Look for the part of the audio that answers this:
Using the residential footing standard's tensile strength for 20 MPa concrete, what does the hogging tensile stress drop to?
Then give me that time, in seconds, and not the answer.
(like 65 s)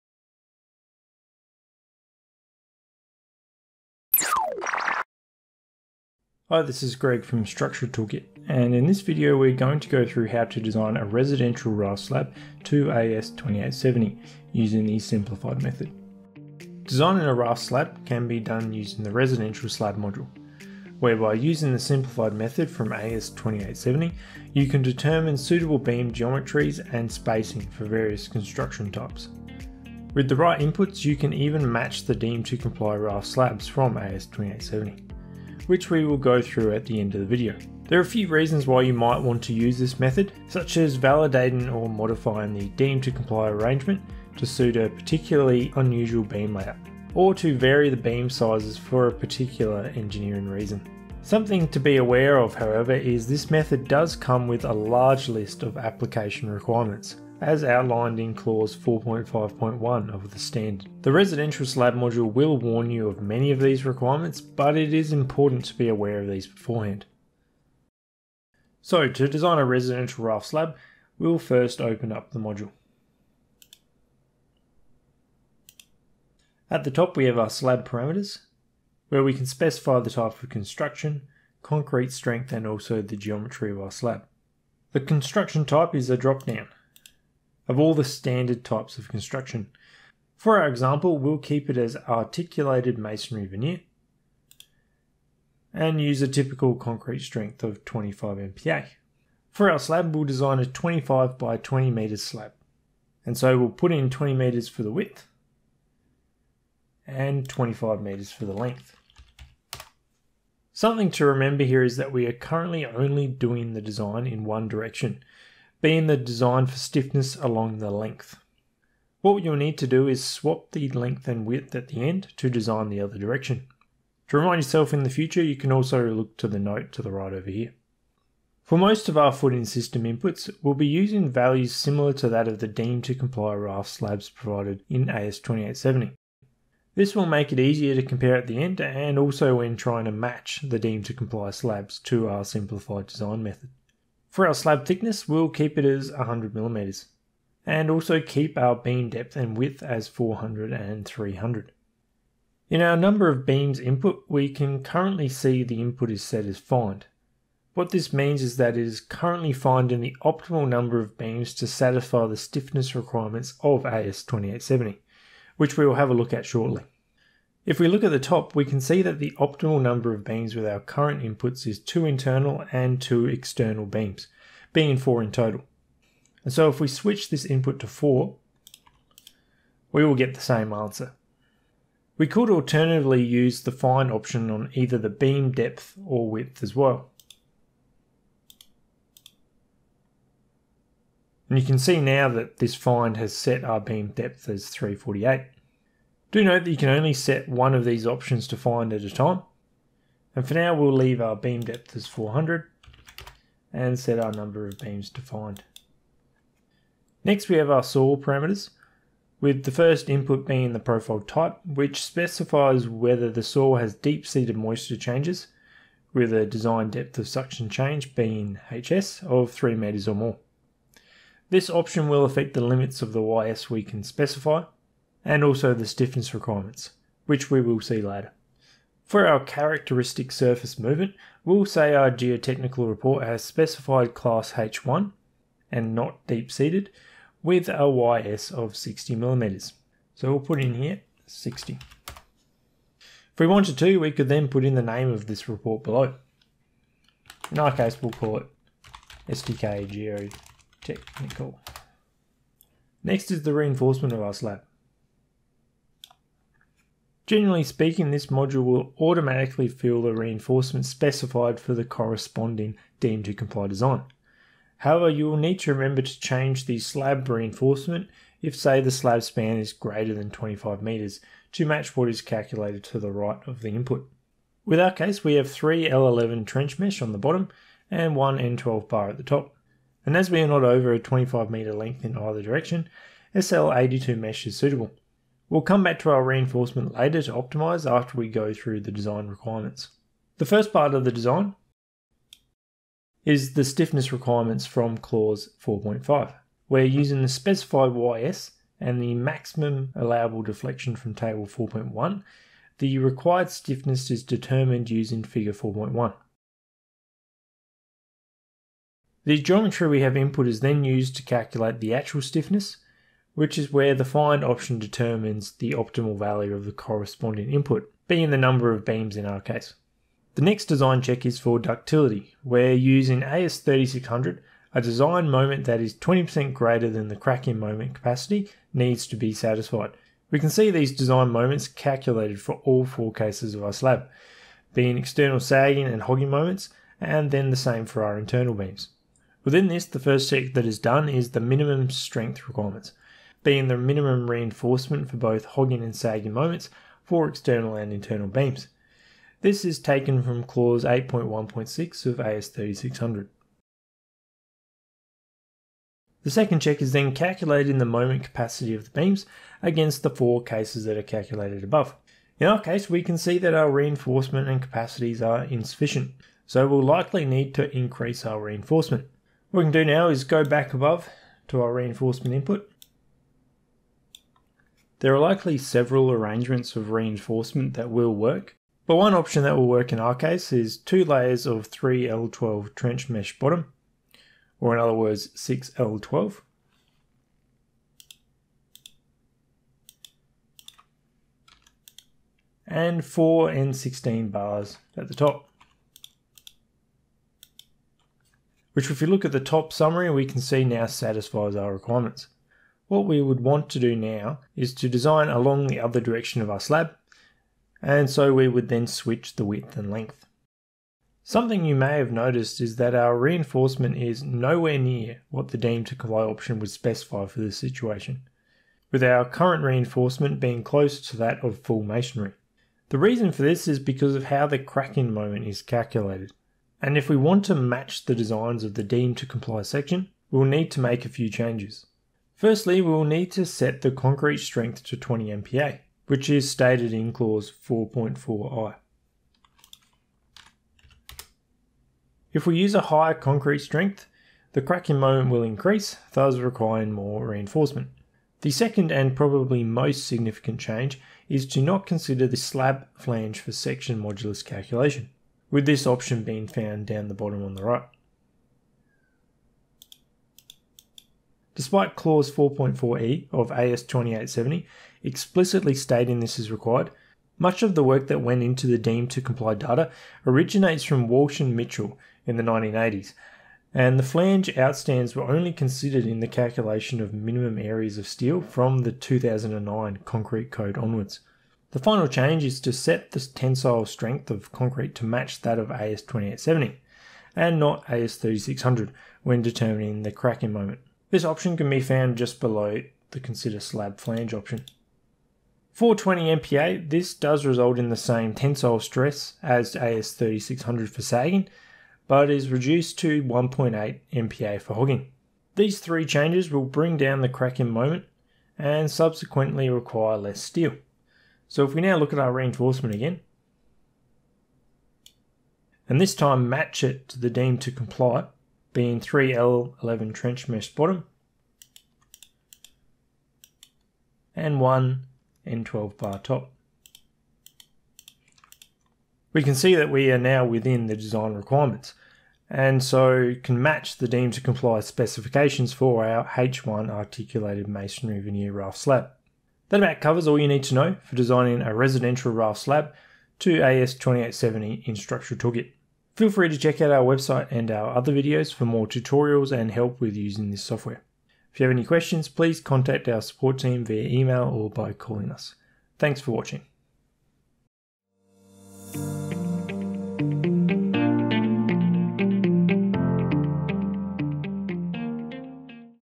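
503 s.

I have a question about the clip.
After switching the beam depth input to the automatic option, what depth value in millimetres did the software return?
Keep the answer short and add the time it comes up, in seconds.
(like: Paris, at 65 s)
348, at 194 s.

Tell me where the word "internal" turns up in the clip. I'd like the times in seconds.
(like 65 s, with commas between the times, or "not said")
172 s, 338 s, 347 s.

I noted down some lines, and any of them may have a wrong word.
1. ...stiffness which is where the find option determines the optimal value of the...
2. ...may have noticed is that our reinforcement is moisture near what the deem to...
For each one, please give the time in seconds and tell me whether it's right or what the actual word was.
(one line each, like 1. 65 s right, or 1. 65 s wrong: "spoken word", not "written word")
1. 312 s right
2. 411 s wrong: "nowhere", not "moisture".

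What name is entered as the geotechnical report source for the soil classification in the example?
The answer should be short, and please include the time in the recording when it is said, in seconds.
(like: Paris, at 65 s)
STK Geotechnical, at 249 s.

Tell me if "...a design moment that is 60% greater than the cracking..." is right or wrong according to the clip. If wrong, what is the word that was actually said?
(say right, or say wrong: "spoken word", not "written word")
wrong: "20", not "60".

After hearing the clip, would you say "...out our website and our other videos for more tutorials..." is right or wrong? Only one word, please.
right.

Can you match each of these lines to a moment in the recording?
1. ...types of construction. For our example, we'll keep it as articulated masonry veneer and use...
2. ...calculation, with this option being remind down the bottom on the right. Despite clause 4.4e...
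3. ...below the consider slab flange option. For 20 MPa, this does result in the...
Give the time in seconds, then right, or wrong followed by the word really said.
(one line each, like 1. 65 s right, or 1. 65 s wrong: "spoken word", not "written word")
1. 88 s right
2. 454 s wrong: "found", not "remind"
3. 492 s right.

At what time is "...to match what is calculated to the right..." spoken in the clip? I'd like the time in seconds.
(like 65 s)
271 s.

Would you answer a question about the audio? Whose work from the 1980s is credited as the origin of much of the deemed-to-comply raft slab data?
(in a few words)
Walsh and Mitchell.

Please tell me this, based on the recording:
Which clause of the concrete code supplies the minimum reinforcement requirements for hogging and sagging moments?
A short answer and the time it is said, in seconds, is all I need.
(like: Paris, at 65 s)
Clause 8.1.6, at 350 s.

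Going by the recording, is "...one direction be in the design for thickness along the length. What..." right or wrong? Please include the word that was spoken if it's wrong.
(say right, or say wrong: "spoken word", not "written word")
wrong: "stiffness", not "thickness".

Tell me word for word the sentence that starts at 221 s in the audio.
This option will affect the limits of the YS we can specify and also the stiffness requirements, which we will see later.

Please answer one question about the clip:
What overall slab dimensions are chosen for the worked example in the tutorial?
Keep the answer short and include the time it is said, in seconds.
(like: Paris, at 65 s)
25 by 20 metres, at 100 s.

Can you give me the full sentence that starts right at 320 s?
The next design check is for ductility.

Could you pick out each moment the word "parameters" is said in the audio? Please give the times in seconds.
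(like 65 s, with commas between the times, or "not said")
77 s, 208 s.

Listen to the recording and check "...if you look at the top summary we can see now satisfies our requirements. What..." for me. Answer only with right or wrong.
right.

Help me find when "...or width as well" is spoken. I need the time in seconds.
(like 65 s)
186 s.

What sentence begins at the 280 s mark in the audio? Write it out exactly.
And as we are not over a 25 metre length in either direction, SL82 mesh is suitable.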